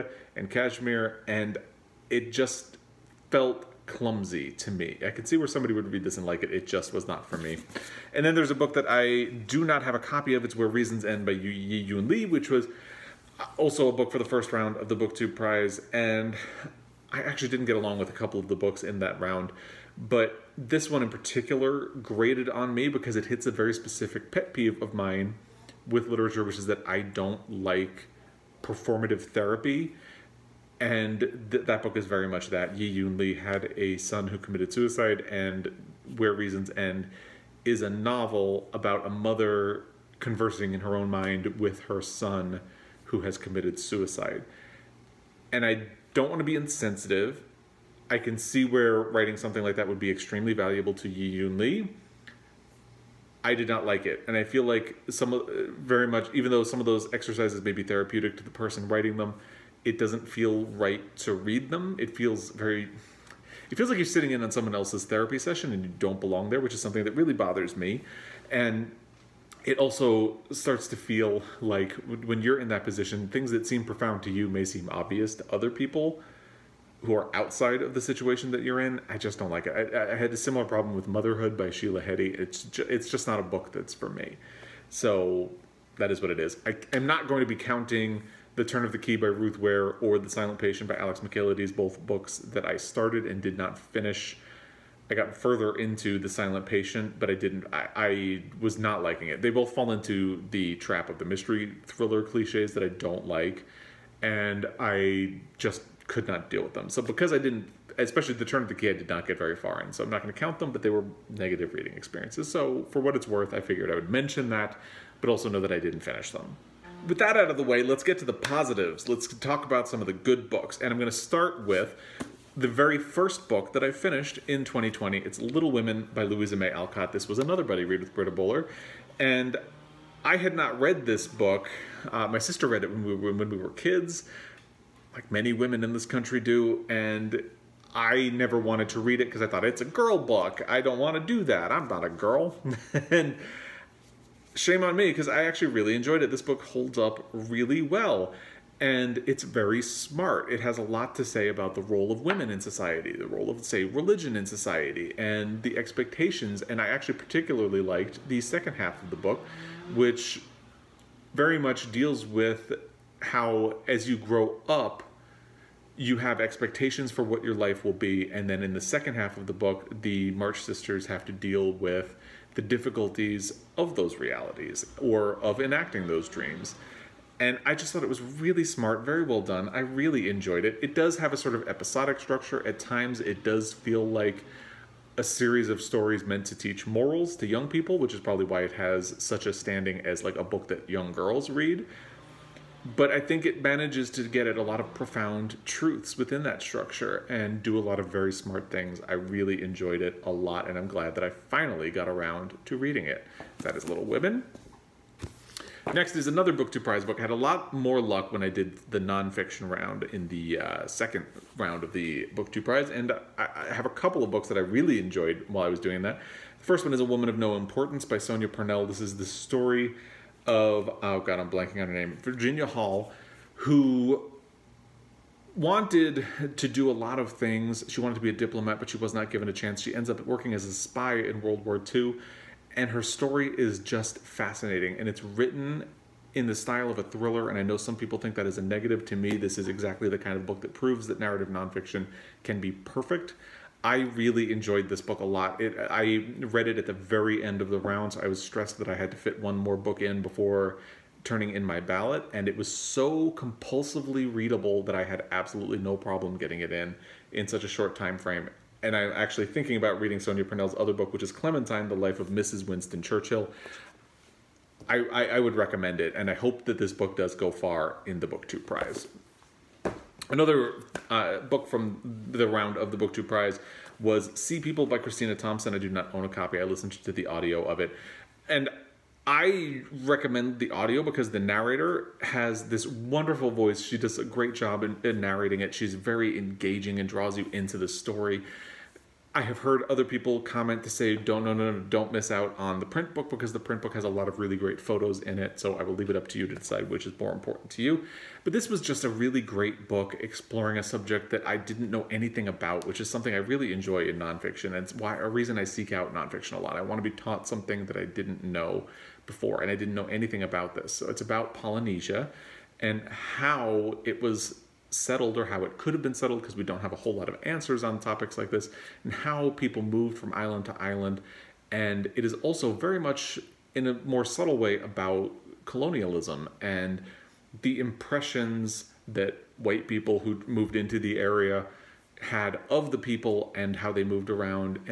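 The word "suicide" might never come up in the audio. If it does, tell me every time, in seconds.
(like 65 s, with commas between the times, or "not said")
34 s, 43 s.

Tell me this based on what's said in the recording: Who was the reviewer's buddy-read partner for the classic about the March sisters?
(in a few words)
Britta Bowler.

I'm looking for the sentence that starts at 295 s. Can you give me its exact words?
So I will leave it up to you to decide which is more important to you.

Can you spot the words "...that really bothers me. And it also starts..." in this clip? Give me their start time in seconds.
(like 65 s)
67 s.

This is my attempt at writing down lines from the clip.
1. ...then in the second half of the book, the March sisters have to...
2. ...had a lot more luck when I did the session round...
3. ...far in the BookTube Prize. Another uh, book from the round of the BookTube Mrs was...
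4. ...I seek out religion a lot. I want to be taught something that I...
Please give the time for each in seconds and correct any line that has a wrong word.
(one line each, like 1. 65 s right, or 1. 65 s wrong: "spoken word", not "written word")
1. 168 s right
2. 207 s wrong: "nonfiction", not "session"
3. 267 s wrong: "Prize", not "Mrs"
4. 305 s wrong: "nonfiction", not "religion".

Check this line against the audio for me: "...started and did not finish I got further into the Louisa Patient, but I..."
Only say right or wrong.
wrong.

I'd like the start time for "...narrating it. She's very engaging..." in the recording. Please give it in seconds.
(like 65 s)
285 s.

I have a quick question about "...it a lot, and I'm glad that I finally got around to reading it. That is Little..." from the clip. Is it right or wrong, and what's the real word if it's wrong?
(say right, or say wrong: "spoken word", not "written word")
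right.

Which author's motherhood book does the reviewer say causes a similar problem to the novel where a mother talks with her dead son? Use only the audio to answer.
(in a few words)
Sheila Heti.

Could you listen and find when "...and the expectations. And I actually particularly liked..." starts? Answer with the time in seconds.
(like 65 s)
155 s.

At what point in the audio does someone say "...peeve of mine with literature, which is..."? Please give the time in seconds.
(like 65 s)
24 s.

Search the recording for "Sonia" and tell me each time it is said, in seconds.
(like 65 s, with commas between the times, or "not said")
218 s, 260 s.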